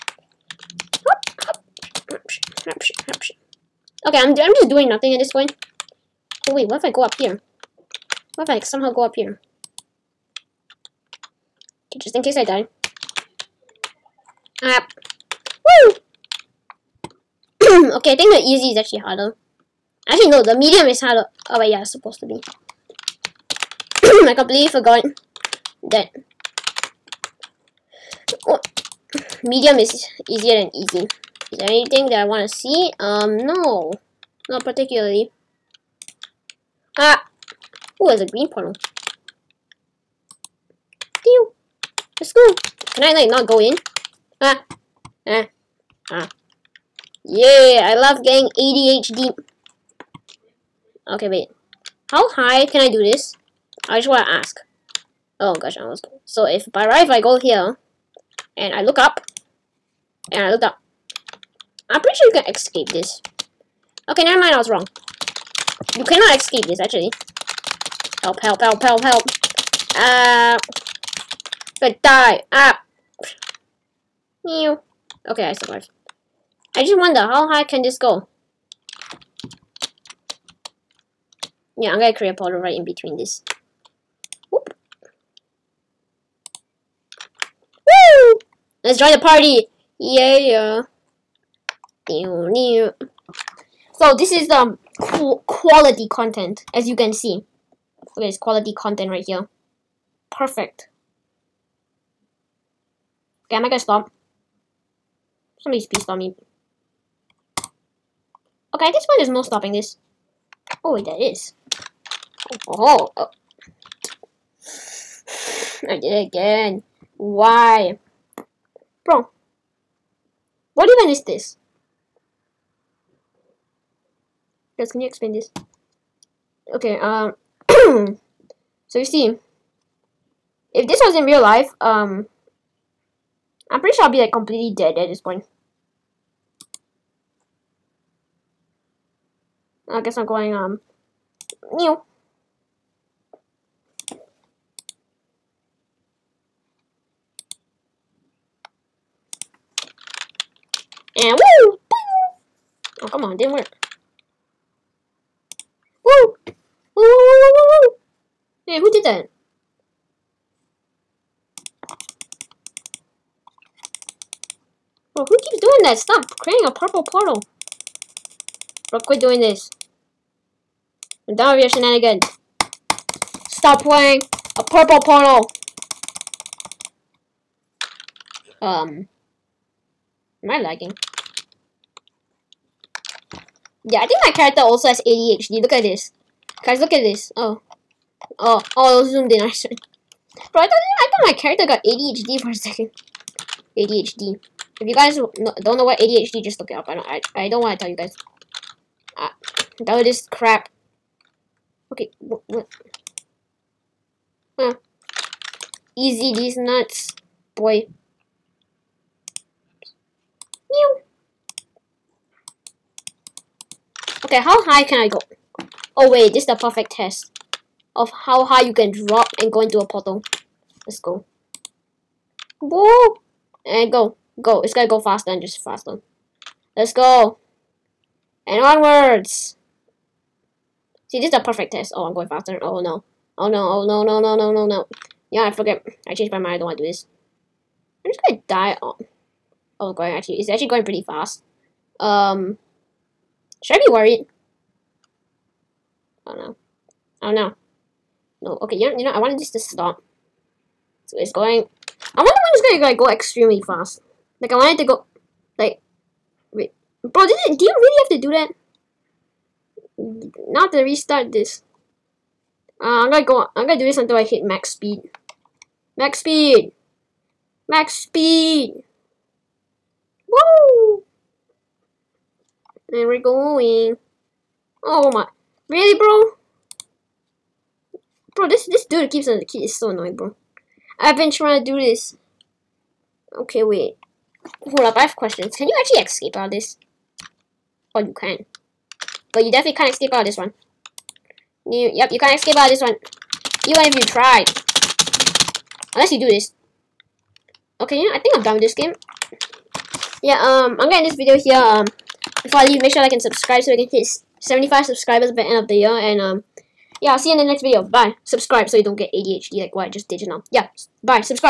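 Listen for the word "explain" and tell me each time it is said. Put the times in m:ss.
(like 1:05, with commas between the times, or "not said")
2:05.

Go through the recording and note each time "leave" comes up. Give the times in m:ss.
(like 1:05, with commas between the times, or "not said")
5:02.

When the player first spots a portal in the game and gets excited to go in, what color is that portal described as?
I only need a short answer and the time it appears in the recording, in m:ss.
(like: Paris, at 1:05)
green, at 0:38.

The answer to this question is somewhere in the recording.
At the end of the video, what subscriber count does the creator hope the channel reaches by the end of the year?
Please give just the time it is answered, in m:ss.
5:04.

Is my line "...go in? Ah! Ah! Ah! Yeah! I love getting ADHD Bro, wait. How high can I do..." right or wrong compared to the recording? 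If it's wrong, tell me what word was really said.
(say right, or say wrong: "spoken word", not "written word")
wrong: "Okay", not "Bro".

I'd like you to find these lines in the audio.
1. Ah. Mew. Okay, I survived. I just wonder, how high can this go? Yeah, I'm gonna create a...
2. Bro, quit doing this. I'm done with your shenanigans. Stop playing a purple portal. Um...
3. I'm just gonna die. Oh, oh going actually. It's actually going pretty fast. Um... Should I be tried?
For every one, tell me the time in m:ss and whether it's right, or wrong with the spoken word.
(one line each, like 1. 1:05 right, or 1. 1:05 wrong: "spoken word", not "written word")
1. 1:12 right
2. 2:48 right
3. 3:58 wrong: "worried", not "tried".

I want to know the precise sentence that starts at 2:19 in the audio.
I guess I'm going, um, new.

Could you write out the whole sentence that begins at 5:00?
Yeah, um, I'm gonna end this video here.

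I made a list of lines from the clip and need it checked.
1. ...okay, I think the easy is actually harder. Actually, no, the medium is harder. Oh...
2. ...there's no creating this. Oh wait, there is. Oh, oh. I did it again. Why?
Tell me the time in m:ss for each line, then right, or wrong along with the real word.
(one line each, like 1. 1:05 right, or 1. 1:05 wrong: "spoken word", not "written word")
1. 0:17 right
2. 1:49 wrong: "stopping", not "creating".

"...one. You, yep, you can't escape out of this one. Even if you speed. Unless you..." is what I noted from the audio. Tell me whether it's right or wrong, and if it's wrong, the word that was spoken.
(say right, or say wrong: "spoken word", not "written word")
wrong: "tried", not "speed".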